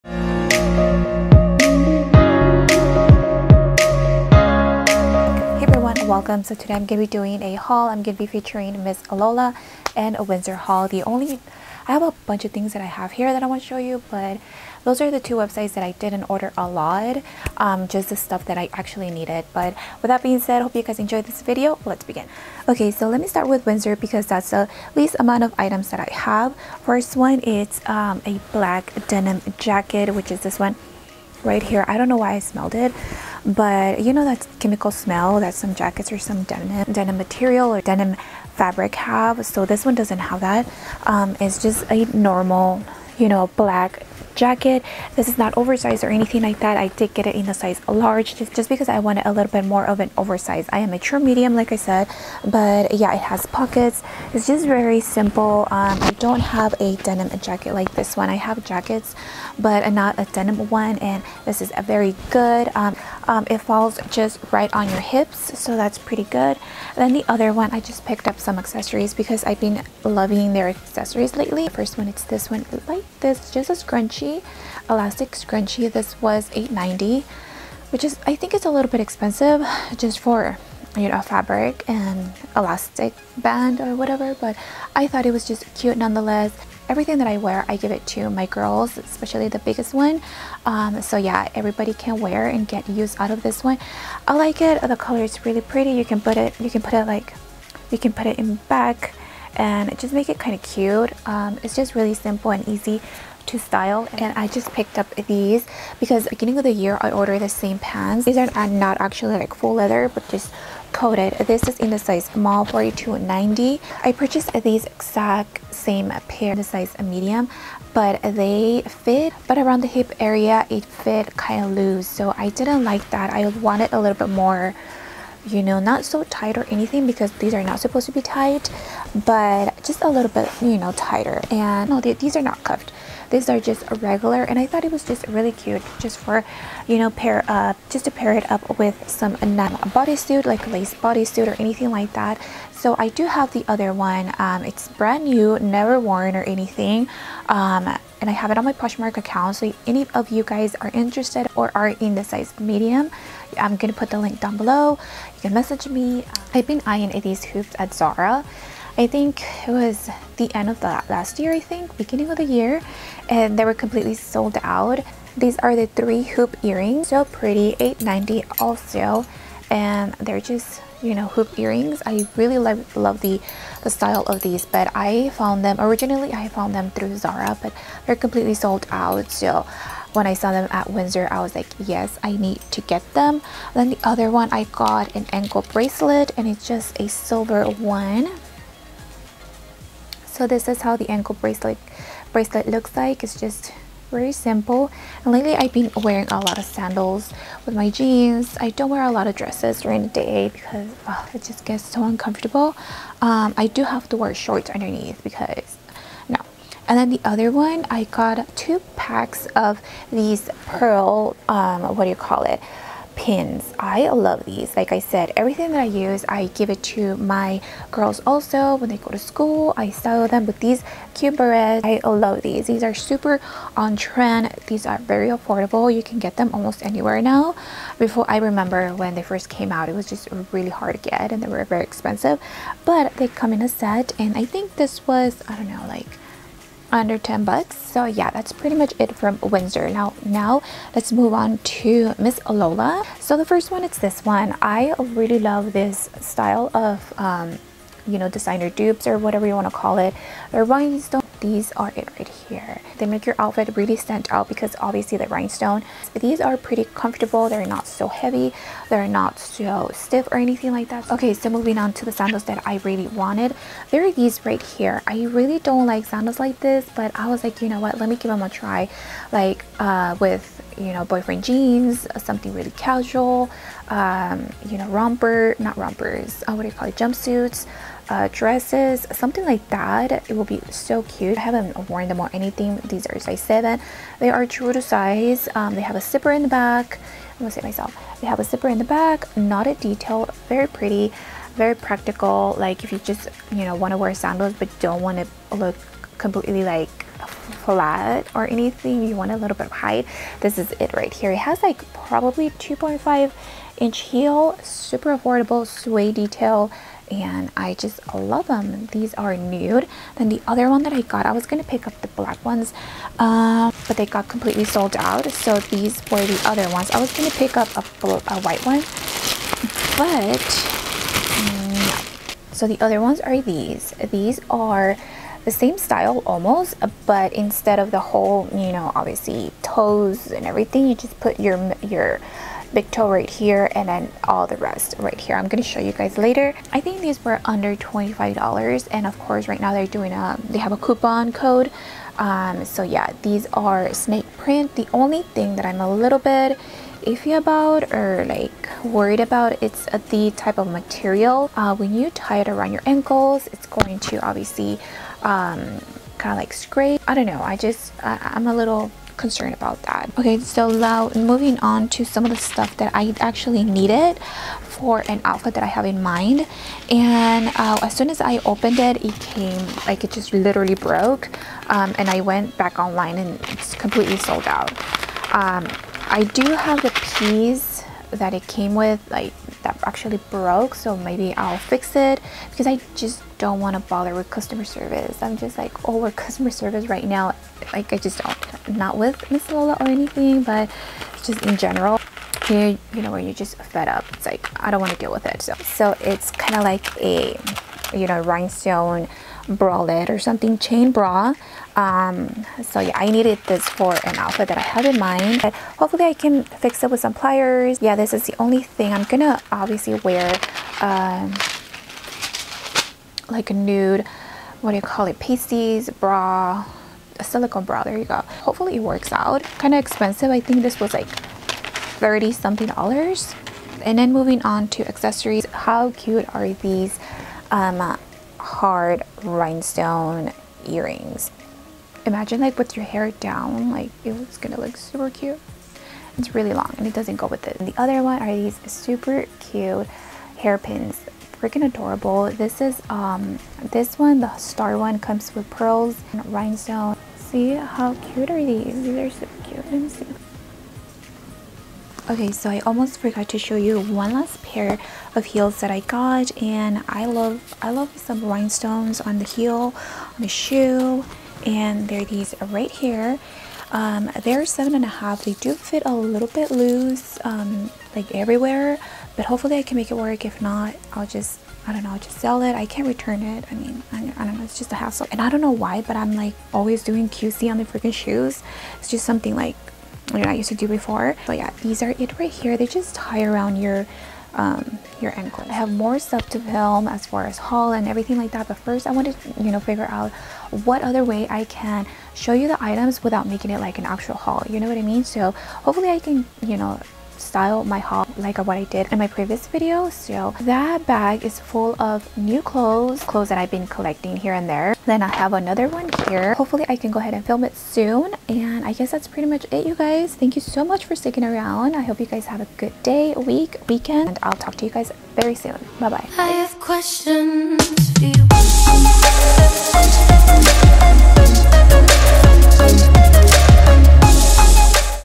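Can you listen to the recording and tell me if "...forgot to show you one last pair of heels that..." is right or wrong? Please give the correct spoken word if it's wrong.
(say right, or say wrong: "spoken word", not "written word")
right.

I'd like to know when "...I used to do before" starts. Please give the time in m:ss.
8:00.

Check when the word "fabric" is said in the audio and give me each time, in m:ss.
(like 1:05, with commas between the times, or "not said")
0:38, 1:21.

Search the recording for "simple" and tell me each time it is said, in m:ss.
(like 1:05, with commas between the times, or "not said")
0:54, 1:42, 3:14.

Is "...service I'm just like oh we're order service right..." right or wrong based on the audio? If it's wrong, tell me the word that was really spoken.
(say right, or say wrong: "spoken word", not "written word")
wrong: "customer", not "order".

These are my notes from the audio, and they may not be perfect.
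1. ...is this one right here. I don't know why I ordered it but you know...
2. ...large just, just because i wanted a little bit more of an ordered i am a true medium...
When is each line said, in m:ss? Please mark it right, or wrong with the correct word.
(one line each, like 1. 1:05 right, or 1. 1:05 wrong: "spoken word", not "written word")
1. 0:30 wrong: "smelled", not "ordered"
2. 0:47 wrong: "oversized", not "ordered".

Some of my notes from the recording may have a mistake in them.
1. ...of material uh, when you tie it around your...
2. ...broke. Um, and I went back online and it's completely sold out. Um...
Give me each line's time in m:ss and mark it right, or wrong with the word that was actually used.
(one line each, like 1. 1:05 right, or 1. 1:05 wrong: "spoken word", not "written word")
1. 5:50 right
2. 6:10 right.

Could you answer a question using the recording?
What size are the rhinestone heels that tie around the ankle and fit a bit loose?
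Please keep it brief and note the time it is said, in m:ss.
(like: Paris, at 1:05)
7.5, at 7:44.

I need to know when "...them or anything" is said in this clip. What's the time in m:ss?
4:42.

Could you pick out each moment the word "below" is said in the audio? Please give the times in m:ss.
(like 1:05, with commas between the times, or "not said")
2:34.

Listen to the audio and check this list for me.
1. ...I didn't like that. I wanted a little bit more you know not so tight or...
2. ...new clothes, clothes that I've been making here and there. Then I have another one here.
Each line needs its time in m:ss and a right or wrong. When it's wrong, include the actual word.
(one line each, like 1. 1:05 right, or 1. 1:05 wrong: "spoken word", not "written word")
1. 2:02 right
2. 8:22 wrong: "collecting", not "making".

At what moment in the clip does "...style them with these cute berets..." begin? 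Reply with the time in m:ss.
3:39.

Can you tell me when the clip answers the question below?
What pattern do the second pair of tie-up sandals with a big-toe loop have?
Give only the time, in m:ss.
5:43.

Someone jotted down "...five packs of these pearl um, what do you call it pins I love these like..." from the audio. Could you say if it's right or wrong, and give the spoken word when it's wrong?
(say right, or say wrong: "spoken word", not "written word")
wrong: "two", not "five".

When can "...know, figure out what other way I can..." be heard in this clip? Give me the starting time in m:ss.
8:09.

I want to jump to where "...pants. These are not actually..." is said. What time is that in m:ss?
1:47.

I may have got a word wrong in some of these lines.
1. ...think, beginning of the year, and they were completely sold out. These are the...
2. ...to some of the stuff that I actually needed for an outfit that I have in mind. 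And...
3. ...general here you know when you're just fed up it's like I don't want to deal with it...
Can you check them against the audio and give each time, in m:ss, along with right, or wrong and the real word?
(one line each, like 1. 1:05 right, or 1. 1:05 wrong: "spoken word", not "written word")
1. 2:41 right
2. 6:01 right
3. 6:31 right.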